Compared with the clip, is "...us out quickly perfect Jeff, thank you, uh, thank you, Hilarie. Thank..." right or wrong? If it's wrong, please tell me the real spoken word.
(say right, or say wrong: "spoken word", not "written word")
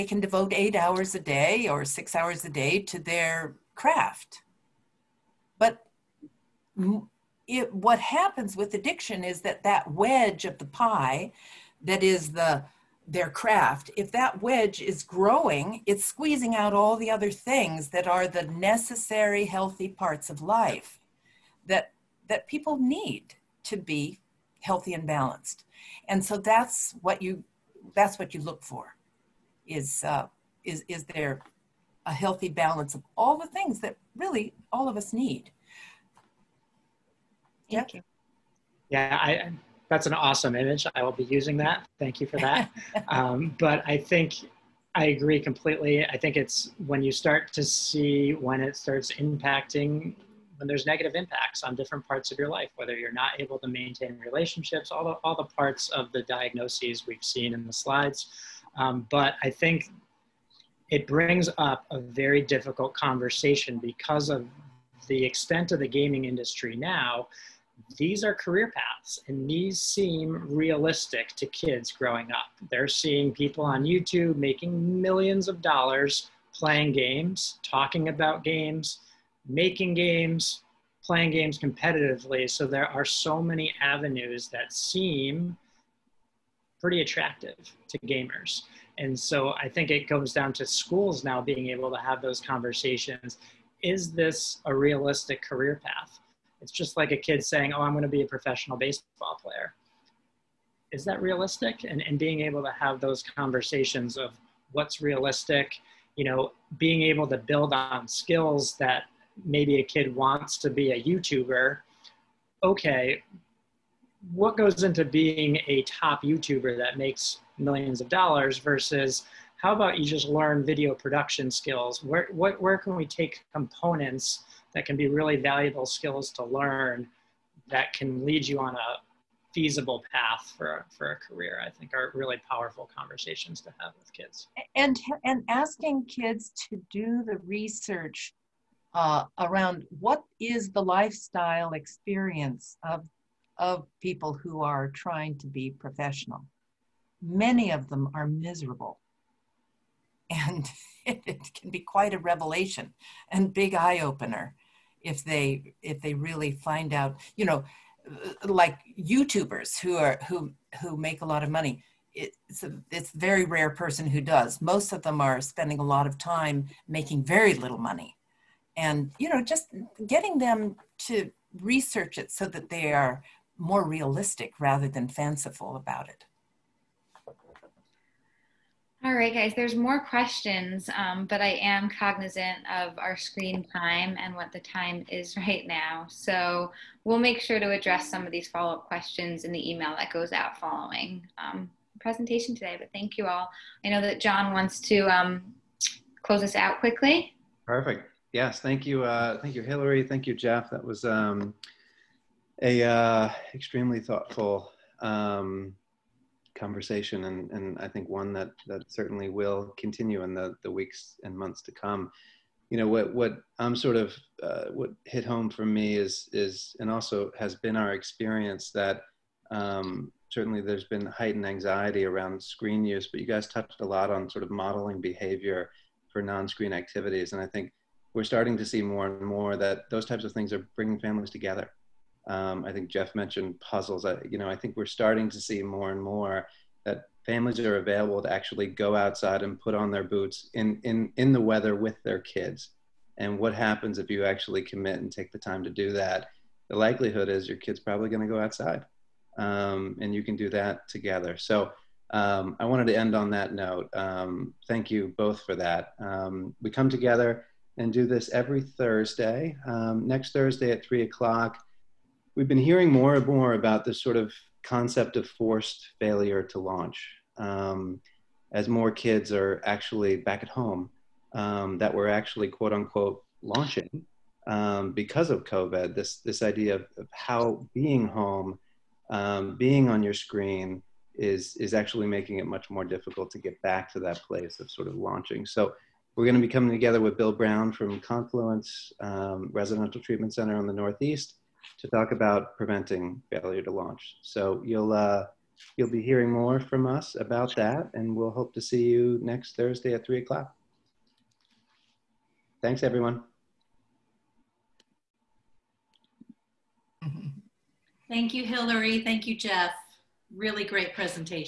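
wrong: "Yes", not "Jeff".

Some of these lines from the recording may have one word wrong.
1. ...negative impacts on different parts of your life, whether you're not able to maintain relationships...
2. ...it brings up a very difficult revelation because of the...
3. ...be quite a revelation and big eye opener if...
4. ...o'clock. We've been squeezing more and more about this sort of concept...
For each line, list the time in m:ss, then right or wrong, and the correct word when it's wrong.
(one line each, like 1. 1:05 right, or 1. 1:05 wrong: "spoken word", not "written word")
1. 0:50 right
2. 1:00 wrong: "conversation", not "revelation"
3. 2:31 right
4. 4:21 wrong: "hearing", not "squeezing".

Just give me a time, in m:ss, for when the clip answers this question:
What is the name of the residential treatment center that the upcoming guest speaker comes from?
4:47.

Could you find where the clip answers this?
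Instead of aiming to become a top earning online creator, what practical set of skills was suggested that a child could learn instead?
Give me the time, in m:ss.
2:00.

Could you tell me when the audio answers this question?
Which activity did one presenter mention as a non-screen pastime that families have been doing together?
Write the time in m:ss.
3:53.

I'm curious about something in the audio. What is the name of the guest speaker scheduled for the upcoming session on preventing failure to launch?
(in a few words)
Bill Brown.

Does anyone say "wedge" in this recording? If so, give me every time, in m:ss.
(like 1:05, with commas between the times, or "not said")
0:09, 0:14.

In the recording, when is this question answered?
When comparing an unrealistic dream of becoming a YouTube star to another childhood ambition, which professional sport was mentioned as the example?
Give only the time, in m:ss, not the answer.
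1:38.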